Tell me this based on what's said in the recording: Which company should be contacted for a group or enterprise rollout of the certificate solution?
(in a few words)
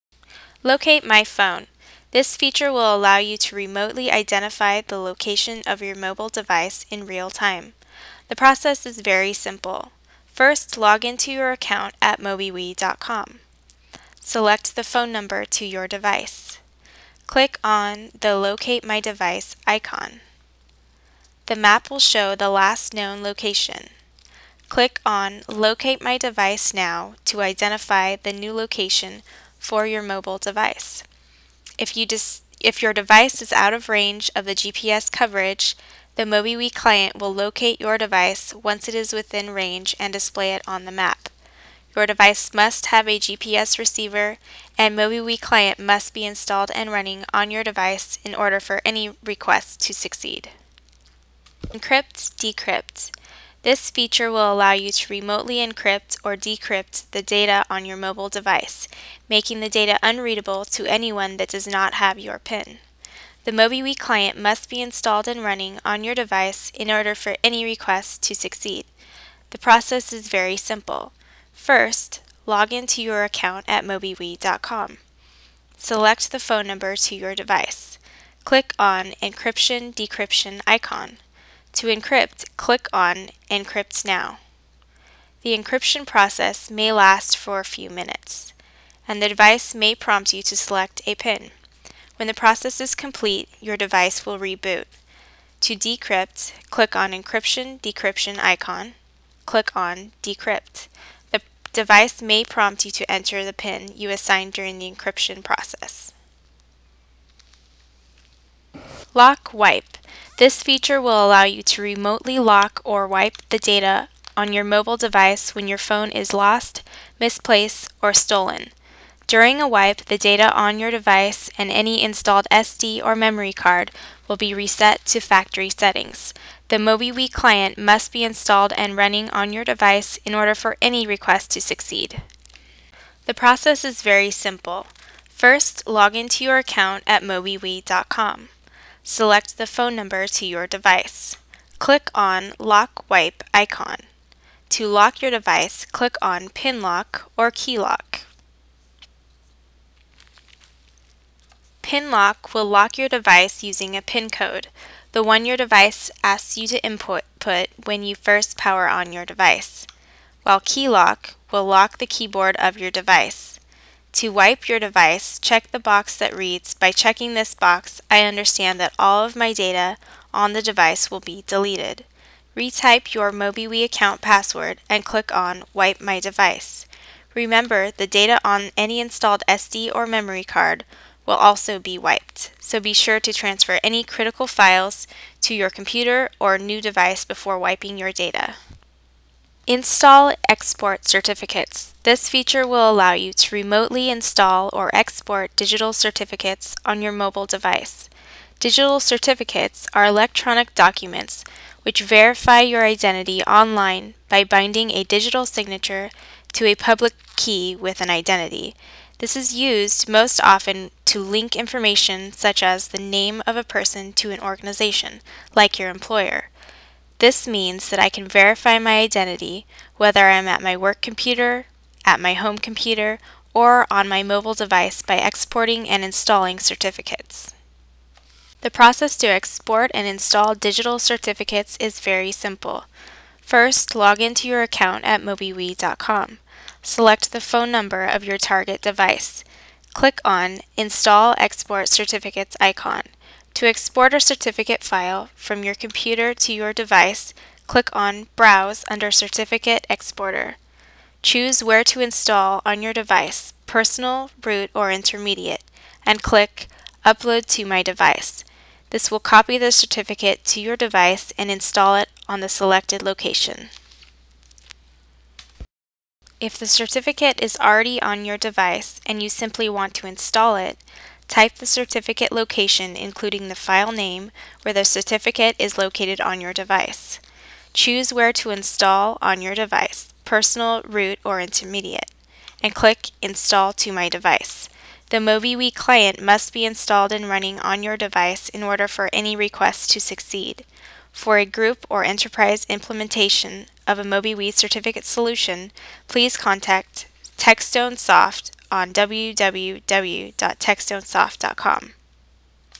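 TechStone Soft.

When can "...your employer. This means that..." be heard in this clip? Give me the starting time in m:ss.
3:35.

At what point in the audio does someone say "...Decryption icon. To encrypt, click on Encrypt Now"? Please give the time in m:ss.
1:19.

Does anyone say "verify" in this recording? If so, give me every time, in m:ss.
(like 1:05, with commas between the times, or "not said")
3:22, 3:38.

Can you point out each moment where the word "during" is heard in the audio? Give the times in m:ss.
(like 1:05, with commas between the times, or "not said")
1:44, 1:59.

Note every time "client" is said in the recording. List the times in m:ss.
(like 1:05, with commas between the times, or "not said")
0:36, 0:45, 1:03, 2:07, 4:45.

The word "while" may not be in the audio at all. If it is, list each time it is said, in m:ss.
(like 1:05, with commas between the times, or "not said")
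2:40.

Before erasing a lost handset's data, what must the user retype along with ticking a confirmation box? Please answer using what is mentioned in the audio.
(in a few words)
MobiWee account password.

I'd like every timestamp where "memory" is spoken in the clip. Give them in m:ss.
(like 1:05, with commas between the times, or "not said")
2:03, 3:00.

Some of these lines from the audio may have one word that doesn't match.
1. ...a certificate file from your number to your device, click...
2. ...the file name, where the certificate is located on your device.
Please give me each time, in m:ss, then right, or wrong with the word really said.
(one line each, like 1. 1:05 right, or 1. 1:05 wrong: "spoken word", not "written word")
1. 4:04 wrong: "computer", not "number"
2. 4:33 right.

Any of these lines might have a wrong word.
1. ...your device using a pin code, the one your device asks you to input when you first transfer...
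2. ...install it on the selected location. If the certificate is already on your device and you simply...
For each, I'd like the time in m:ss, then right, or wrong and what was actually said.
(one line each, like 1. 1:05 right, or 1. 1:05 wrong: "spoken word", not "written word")
1. 2:32 wrong: "power", not "transfer"
2. 4:21 right.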